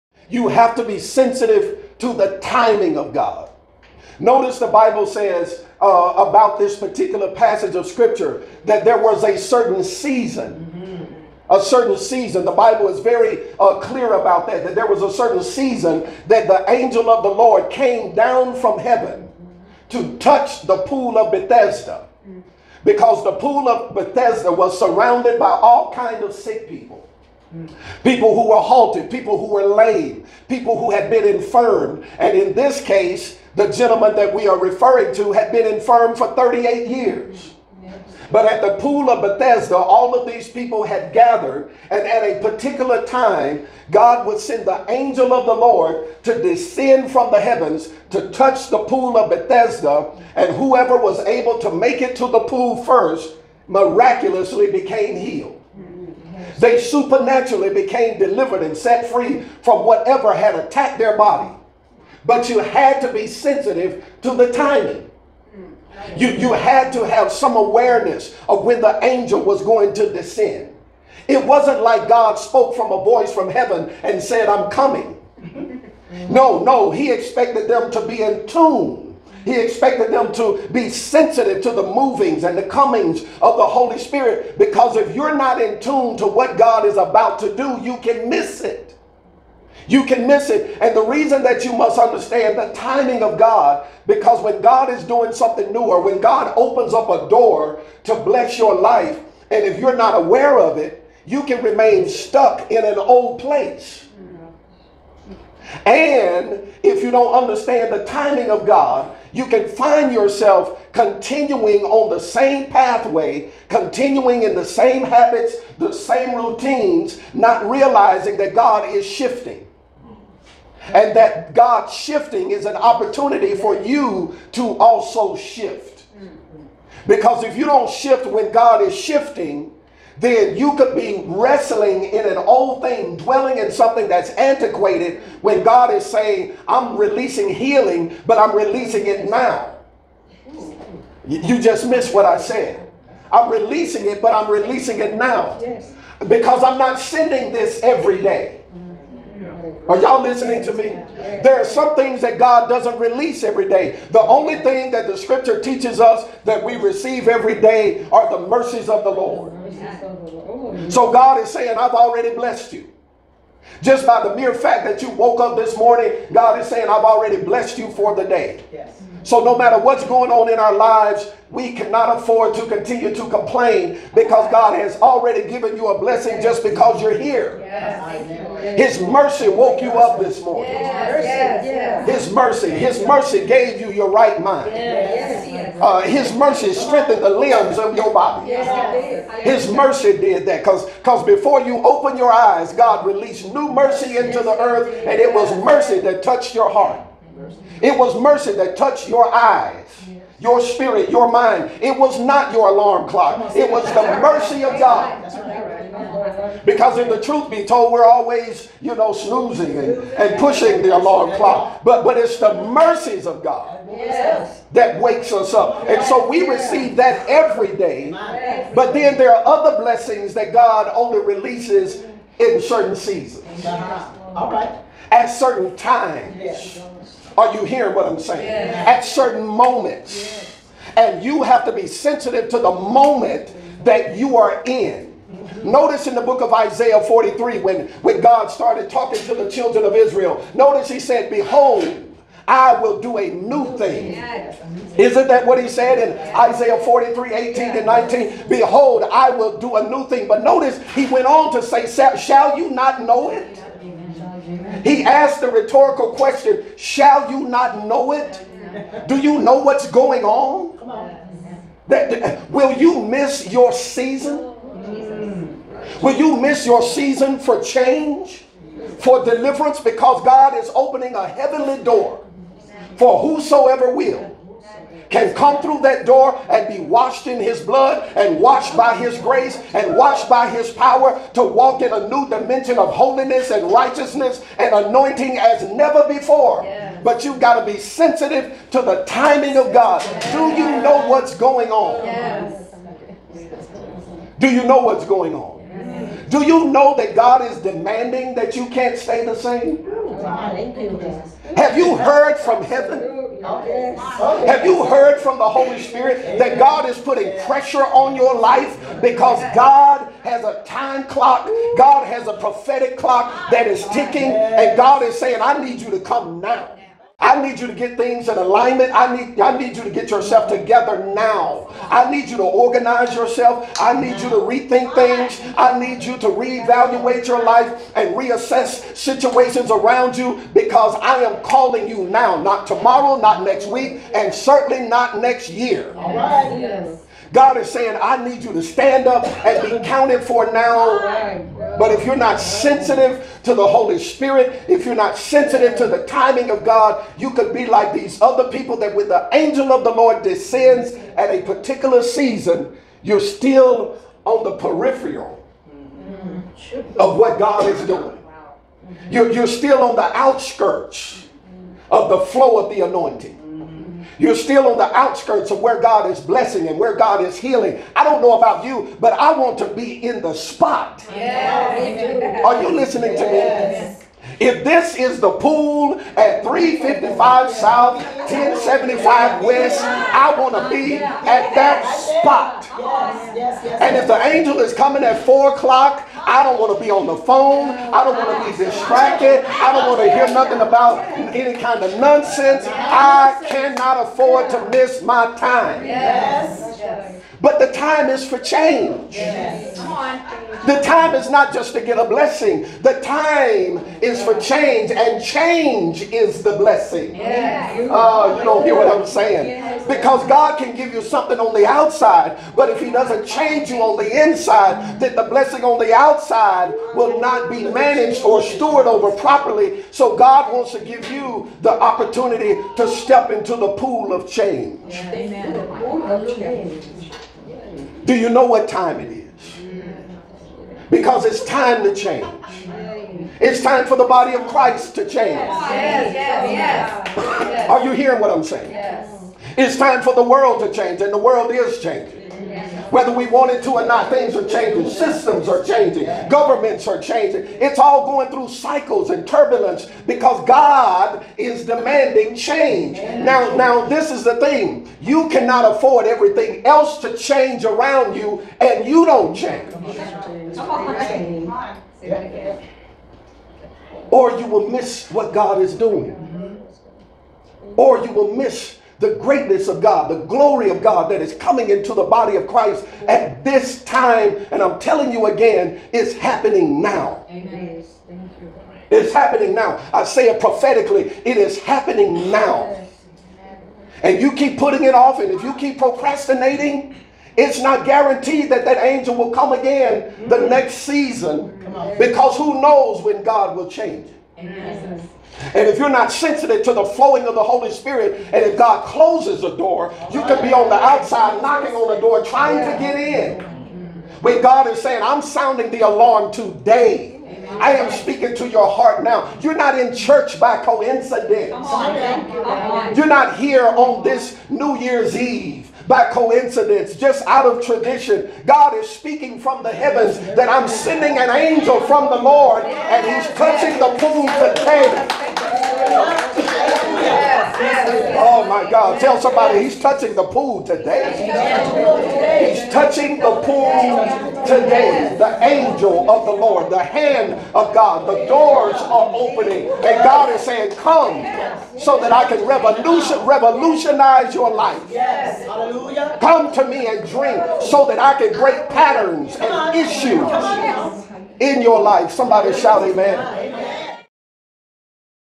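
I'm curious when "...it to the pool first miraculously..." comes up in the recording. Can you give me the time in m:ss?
0:52.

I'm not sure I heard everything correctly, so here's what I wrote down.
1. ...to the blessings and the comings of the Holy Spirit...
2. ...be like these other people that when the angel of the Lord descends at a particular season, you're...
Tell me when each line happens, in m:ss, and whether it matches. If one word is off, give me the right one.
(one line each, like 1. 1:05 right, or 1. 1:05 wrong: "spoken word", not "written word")
1. 1:21 wrong: "movings", not "blessings"
2. 5:47 right.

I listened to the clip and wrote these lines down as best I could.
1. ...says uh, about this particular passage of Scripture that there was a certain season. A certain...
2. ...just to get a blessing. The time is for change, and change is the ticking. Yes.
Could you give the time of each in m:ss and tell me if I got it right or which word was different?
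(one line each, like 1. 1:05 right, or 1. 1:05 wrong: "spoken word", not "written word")
1. 0:05 right
2. 6:41 wrong: "blessing", not "ticking".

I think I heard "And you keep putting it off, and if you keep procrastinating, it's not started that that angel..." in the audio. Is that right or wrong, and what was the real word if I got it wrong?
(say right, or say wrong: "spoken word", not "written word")
wrong: "guaranteed", not "started".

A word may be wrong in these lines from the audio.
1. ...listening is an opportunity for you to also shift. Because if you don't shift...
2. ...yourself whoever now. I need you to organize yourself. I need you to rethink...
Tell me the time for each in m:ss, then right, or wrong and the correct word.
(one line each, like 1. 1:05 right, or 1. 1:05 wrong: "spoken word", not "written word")
1. 2:01 wrong: "shifting", not "listening"
2. 5:20 wrong: "together", not "whoever".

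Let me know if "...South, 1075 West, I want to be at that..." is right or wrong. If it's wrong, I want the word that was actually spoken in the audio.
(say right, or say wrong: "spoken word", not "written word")
right.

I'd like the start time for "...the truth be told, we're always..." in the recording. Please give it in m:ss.
3:27.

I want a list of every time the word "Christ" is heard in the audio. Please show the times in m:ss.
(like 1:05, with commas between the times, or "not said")
7:14, 7:52.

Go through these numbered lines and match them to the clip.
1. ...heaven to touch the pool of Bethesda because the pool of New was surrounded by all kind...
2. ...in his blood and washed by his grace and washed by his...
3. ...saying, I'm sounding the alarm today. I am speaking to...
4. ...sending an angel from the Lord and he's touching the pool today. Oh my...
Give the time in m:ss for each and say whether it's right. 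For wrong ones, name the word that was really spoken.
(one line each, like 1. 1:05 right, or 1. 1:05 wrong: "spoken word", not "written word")
1. 0:18 wrong: "Bethesda", not "New"
2. 4:37 right
3. 8:24 right
4. 8:40 right.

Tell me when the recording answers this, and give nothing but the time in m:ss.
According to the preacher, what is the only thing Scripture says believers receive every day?
2:38.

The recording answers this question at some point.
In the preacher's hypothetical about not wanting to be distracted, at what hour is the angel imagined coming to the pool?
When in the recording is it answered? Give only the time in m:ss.
6:25.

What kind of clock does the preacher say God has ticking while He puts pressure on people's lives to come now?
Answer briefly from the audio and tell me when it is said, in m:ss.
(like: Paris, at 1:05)
A prophetic clock, at 5:12.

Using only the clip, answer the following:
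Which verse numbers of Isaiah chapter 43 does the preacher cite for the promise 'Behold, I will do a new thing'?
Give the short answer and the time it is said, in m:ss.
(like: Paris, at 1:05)
18 and 19, at 4:07.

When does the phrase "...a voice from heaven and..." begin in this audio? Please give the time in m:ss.
1:12.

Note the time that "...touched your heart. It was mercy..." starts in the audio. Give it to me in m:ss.
3:16.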